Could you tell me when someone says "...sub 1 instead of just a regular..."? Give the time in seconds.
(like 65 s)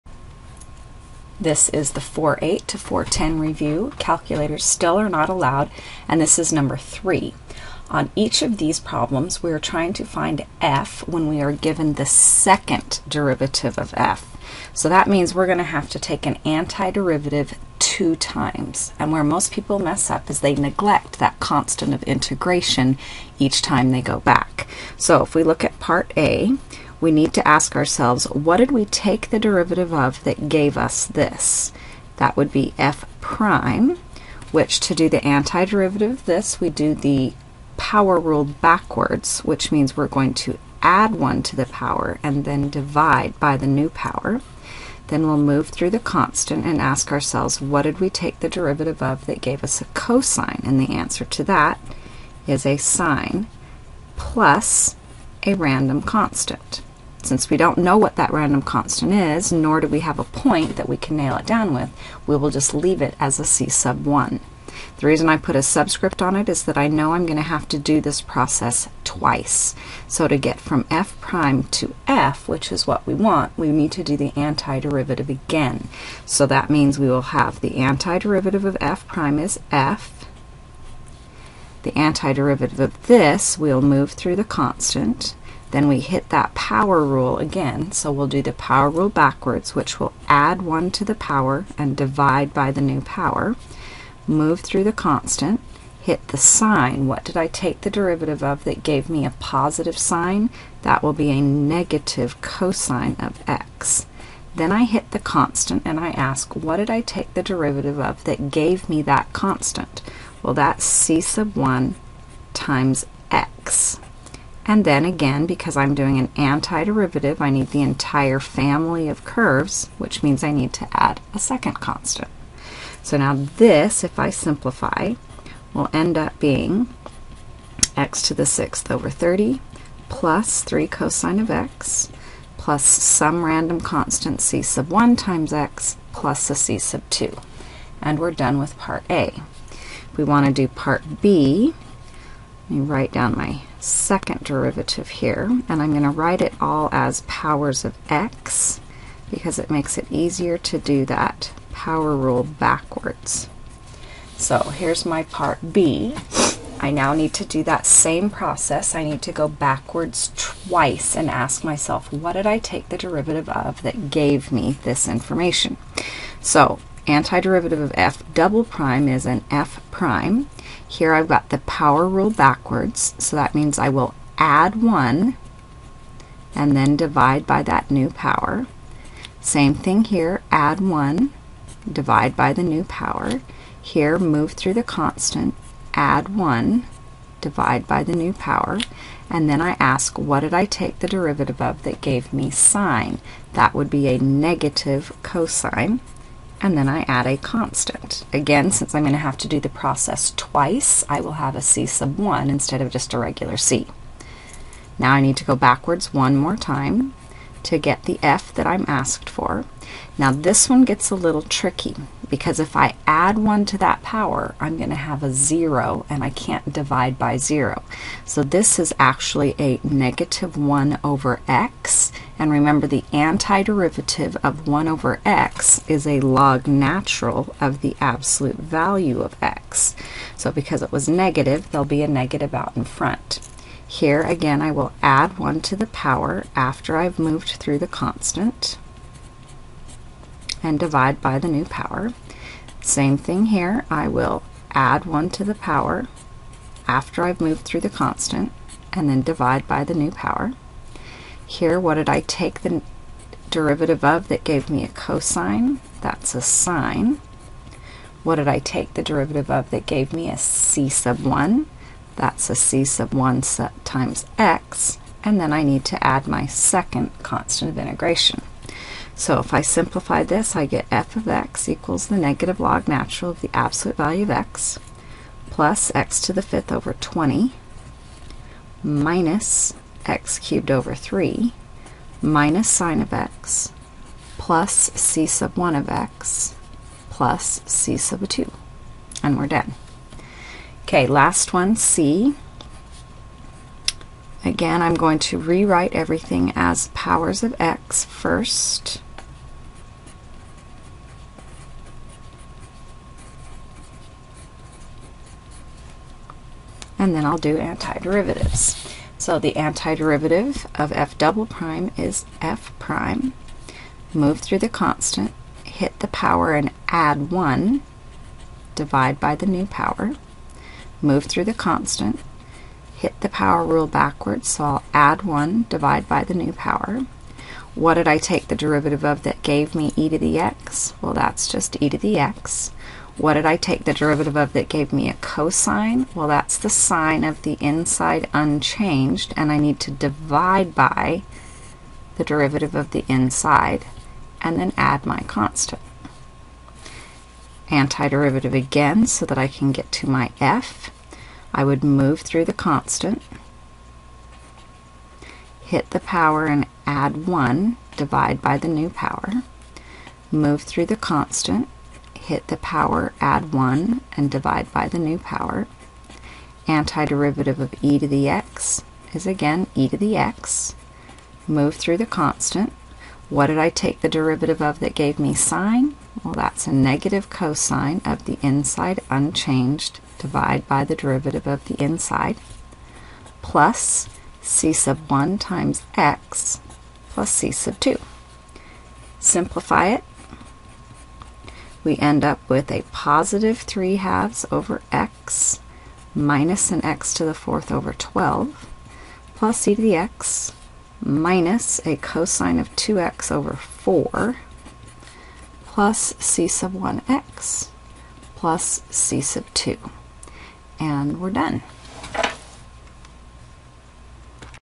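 201 s.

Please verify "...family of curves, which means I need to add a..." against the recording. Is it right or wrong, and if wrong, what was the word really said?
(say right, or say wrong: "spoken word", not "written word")
right.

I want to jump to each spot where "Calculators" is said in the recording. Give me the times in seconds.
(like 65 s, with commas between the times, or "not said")
3 s.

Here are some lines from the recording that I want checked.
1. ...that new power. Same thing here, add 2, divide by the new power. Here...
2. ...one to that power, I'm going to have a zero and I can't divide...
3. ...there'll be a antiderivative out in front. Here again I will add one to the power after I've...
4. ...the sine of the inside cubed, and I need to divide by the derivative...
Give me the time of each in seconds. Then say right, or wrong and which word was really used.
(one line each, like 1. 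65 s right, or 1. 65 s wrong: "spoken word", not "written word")
1. 177 s wrong: "1", not "2"
2. 213 s right
3. 231 s wrong: "negative", not "antiderivative"
4. 336 s wrong: "unchanged", not "cubed".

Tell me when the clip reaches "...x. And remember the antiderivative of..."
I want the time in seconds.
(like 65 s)
221 s.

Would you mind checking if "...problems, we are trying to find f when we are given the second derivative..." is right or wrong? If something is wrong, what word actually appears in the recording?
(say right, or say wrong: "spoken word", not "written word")
right.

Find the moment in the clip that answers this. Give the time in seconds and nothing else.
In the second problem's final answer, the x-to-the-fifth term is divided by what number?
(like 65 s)
276 s.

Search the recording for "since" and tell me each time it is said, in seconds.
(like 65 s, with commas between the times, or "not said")
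57 s, 198 s.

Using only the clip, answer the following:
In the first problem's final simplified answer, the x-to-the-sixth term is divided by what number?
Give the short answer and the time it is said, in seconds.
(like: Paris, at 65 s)
30, at 129 s.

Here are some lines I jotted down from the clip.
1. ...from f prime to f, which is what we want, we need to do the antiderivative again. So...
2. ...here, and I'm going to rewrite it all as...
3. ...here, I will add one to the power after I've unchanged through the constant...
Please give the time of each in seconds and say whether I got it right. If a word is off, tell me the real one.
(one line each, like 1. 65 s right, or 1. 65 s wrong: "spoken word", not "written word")
1. 70 s right
2. 145 s wrong: "write", not "rewrite"
3. 243 s wrong: "moved", not "unchanged".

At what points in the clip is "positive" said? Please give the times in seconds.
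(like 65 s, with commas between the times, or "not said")
99 s, 392 s.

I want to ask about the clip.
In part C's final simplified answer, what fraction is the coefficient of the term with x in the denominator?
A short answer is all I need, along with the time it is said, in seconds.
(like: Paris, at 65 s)
3/2, at 393 s.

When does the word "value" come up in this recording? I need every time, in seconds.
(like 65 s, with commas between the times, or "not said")
228 s, 273 s.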